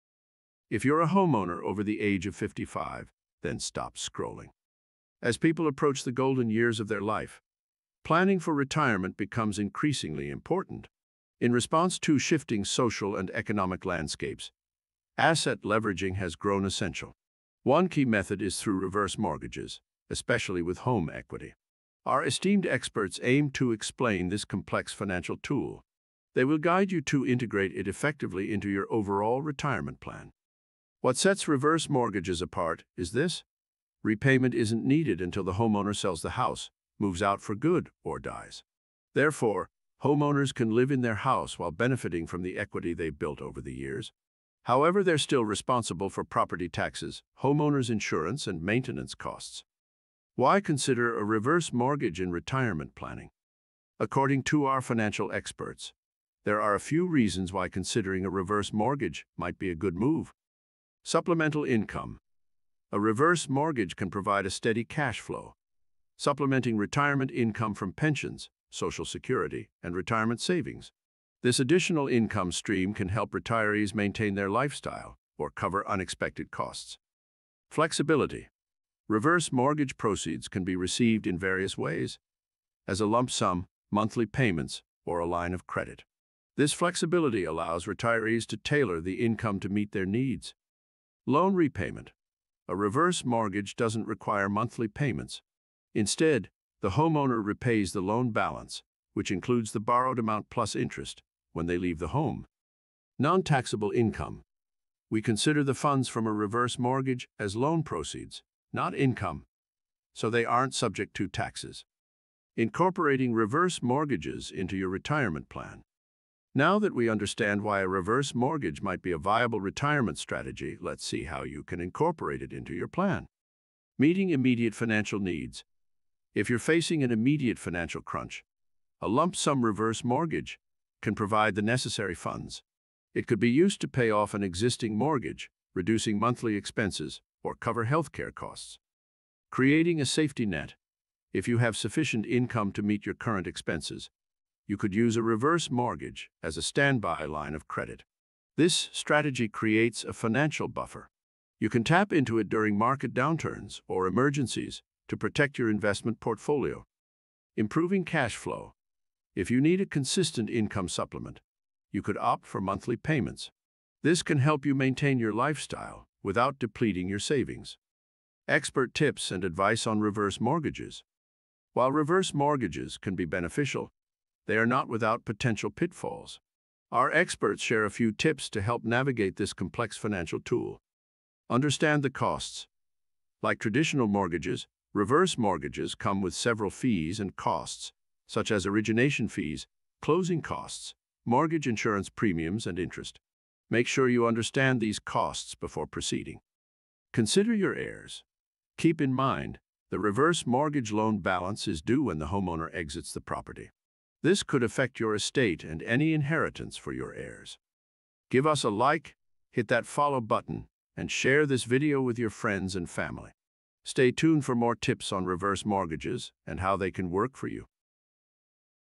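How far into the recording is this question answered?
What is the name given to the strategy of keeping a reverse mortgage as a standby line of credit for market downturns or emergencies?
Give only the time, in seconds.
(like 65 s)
140 s.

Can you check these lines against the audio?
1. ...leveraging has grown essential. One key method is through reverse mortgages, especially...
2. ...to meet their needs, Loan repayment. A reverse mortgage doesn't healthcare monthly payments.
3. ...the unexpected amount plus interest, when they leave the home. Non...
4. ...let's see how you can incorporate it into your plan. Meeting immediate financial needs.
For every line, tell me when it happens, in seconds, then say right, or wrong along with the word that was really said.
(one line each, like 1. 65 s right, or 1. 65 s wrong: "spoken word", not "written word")
1. 15 s right
2. 89 s wrong: "require", not "healthcare"
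3. 99 s wrong: "borrowed", not "unexpected"
4. 120 s right.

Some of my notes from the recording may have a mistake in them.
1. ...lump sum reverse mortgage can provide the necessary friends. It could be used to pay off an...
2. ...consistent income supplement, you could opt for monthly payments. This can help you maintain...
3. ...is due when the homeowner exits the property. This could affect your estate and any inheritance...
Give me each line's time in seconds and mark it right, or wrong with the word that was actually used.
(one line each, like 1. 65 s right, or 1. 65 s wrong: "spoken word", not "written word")
1. 129 s wrong: "funds", not "friends"
2. 159 s right
3. 201 s right.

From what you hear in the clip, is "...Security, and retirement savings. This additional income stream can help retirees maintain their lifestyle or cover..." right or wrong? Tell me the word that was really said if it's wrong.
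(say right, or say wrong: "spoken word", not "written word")
right.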